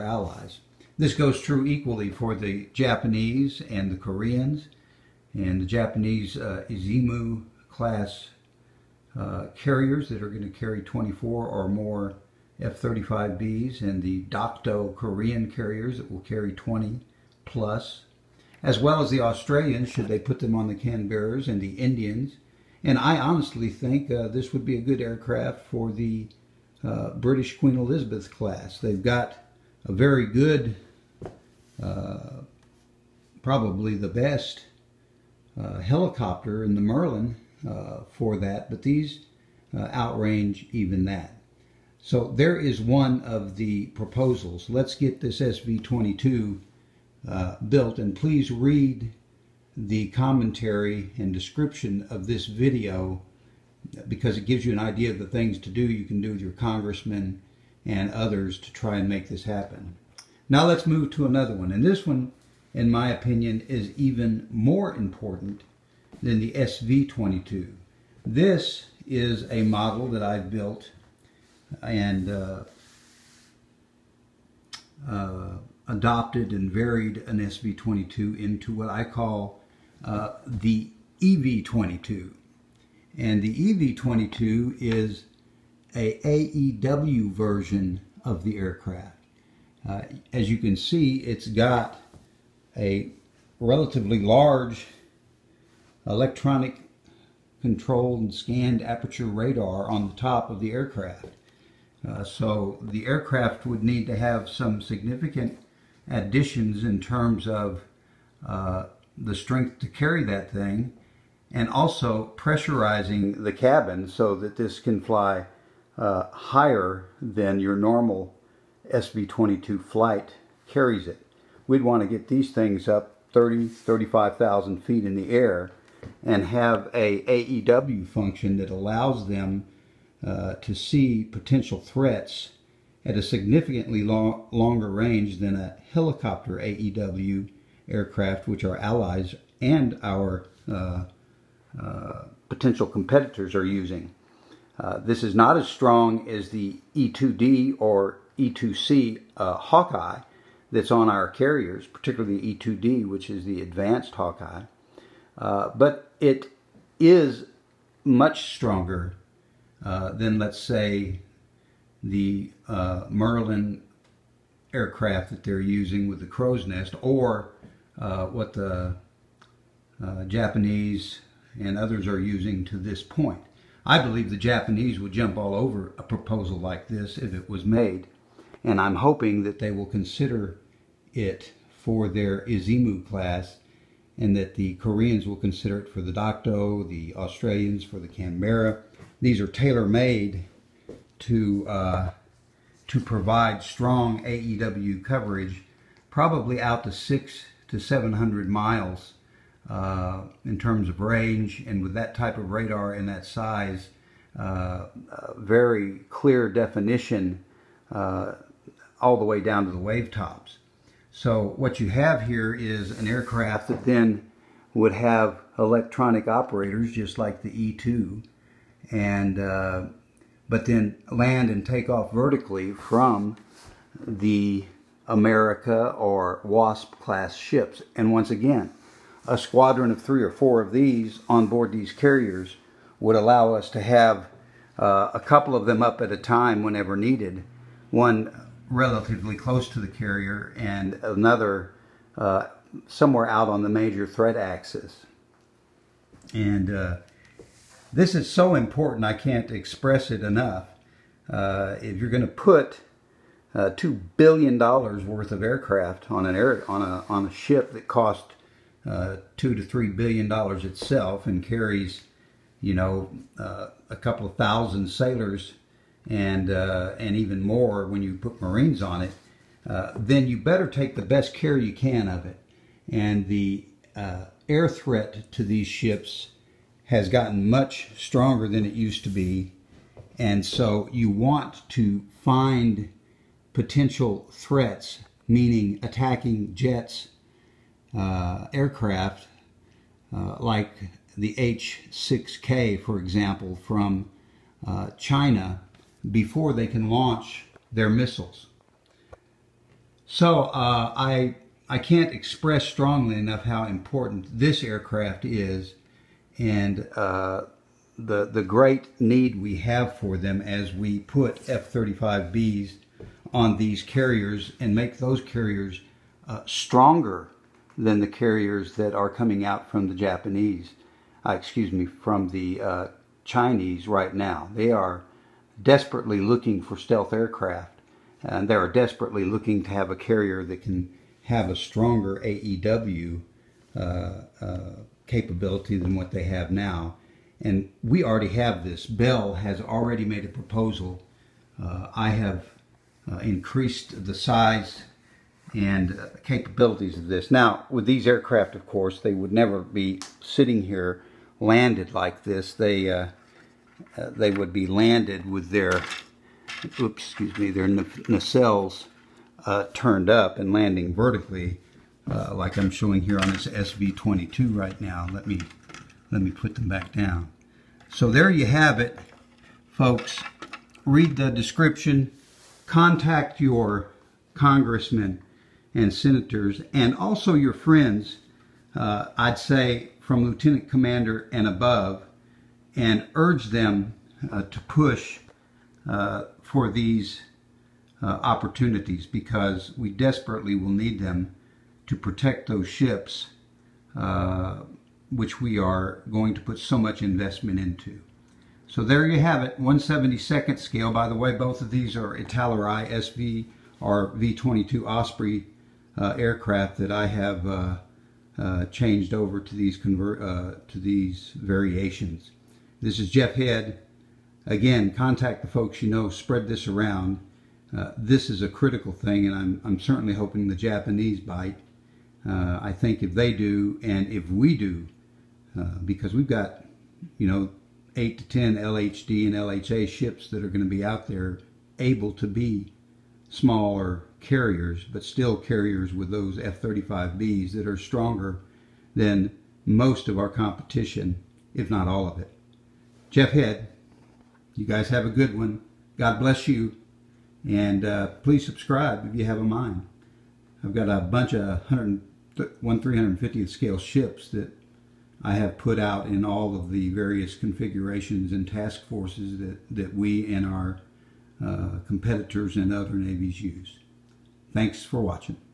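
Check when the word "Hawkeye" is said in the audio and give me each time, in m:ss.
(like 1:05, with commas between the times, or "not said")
2:29, 2:34.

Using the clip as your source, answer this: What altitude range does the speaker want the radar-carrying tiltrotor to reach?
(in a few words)
30,000-35,000 feet.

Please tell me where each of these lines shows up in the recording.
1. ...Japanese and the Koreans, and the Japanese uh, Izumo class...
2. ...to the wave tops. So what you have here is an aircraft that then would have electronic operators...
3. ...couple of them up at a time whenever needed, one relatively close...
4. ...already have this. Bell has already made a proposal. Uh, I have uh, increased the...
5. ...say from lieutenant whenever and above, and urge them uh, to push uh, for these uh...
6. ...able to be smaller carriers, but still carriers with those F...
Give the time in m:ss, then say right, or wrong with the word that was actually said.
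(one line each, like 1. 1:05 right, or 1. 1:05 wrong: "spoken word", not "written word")
1. 0:02 right
2. 3:29 right
3. 3:55 right
4. 5:38 right
5. 6:19 wrong: "commander", not "whenever"
6. 7:11 right.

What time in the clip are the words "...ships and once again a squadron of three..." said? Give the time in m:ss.
3:47.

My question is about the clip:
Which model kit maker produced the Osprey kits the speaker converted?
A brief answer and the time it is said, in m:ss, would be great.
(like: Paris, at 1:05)
Italeri, at 6:42.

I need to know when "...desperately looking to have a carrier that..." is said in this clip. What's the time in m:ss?
5:28.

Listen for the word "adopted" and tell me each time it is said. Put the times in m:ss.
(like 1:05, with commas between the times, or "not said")
1:15.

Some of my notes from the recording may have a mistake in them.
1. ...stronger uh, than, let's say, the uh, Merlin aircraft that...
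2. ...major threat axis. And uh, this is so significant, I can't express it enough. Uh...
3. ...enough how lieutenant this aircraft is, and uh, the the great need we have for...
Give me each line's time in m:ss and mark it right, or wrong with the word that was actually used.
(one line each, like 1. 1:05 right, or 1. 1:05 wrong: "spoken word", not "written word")
1. 2:38 right
2. 4:03 wrong: "important", not "significant"
3. 5:03 wrong: "important", not "lieutenant".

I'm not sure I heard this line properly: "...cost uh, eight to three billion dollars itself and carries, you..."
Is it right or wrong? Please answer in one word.
wrong.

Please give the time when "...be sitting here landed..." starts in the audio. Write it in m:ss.
5:49.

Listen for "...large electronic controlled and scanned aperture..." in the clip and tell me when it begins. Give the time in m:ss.
1:34.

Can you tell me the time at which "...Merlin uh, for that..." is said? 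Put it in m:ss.
0:36.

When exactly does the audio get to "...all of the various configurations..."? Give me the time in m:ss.
7:36.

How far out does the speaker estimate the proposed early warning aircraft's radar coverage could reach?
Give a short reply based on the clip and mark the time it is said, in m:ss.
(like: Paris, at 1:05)
600 to 700 miles, at 3:16.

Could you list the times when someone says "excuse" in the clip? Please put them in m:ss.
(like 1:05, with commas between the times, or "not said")
5:21, 5:57.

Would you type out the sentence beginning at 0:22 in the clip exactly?
And I honestly think uh, this would be a good aircraft for the uh, British Queen Elizabeth class.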